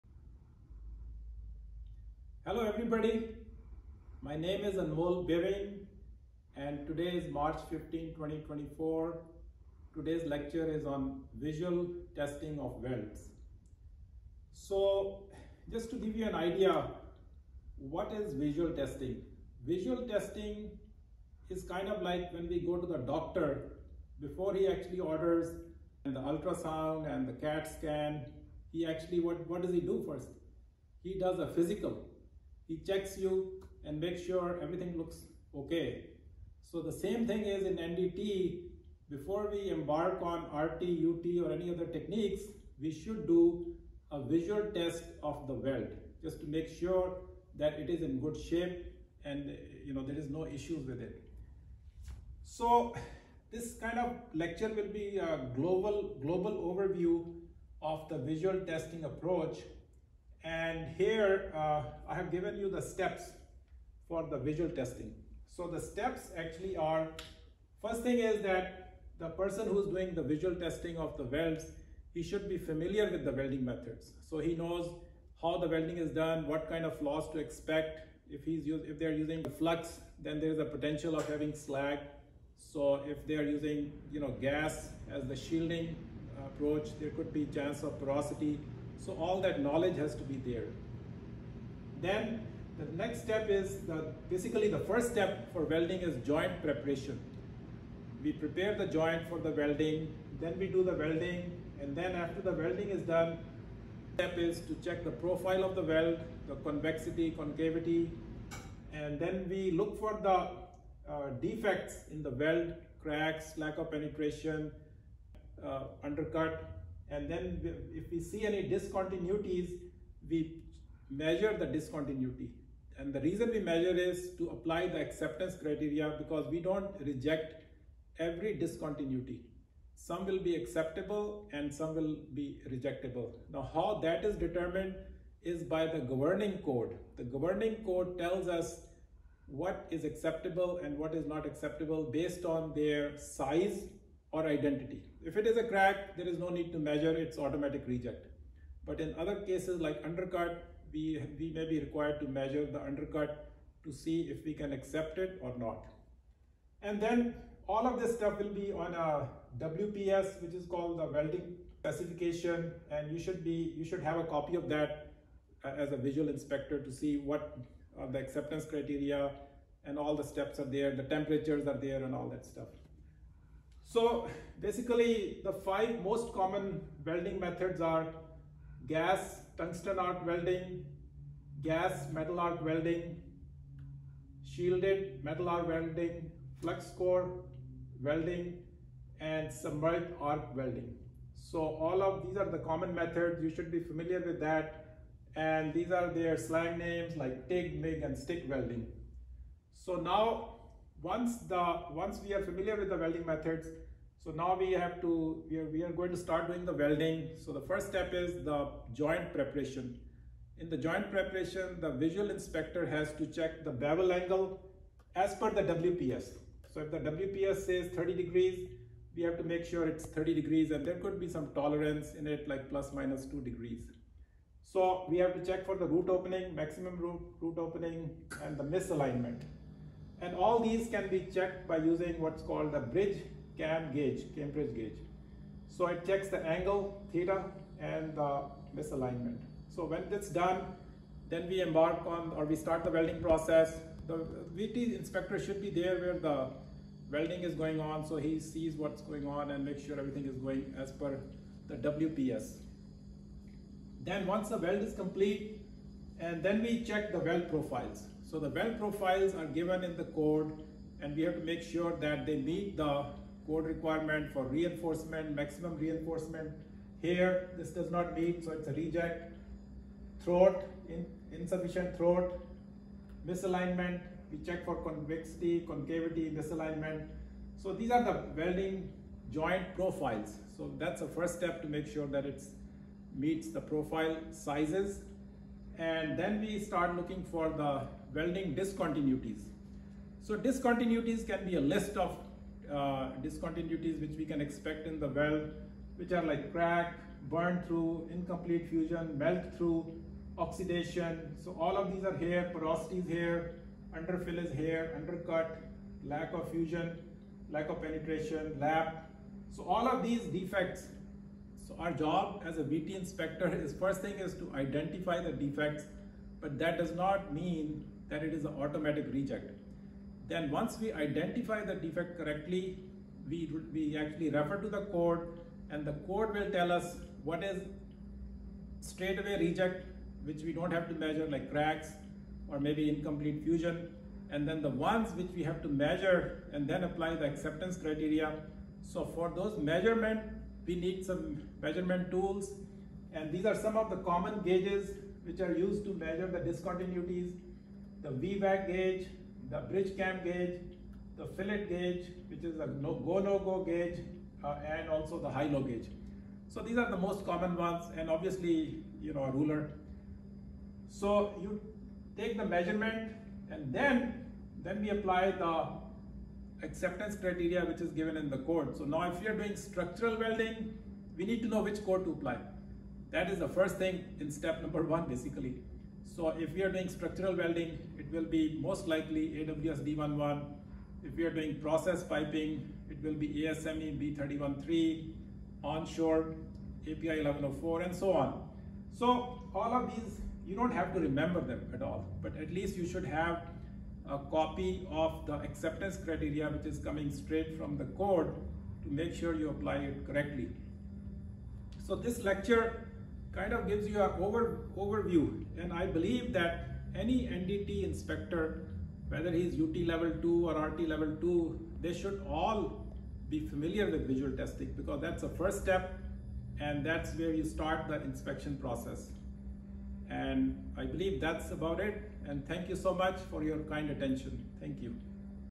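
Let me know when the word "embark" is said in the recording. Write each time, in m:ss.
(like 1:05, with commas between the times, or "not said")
0:39, 4:01.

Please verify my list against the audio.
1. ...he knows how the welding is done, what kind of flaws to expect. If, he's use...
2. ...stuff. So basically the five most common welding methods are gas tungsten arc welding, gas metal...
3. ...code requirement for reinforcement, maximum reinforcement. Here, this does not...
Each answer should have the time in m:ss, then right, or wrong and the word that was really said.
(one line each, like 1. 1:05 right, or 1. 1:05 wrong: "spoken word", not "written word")
1. 1:14 right
2. 2:52 right
3. 4:23 right.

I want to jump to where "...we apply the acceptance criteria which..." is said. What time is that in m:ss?
6:04.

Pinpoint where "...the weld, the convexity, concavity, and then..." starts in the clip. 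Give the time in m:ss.
1:45.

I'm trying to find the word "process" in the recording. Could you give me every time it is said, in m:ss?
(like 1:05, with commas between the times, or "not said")
4:03, 6:21, 6:58.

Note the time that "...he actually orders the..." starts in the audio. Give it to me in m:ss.
0:24.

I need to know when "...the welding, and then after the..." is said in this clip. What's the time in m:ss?
1:40.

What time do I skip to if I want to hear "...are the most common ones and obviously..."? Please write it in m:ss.
5:56.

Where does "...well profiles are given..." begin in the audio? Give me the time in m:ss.
4:18.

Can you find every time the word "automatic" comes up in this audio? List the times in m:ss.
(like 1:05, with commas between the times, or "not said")
2:27, 5:18.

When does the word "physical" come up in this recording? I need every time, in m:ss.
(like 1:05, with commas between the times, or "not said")
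0:31.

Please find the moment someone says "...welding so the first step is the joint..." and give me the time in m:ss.
3:26.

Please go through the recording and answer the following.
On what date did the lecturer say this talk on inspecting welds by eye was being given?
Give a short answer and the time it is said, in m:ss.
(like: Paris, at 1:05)
March 15, 2024, at 0:07.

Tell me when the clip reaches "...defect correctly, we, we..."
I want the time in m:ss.
5:21.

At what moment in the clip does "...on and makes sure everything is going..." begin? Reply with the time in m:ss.
4:09.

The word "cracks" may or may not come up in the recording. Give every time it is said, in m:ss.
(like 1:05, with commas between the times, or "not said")
1:53, 2:25, 4:56, 5:31.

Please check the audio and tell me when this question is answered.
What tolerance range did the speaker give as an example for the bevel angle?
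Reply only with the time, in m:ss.
3:42.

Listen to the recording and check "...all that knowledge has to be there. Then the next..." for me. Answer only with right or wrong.
right.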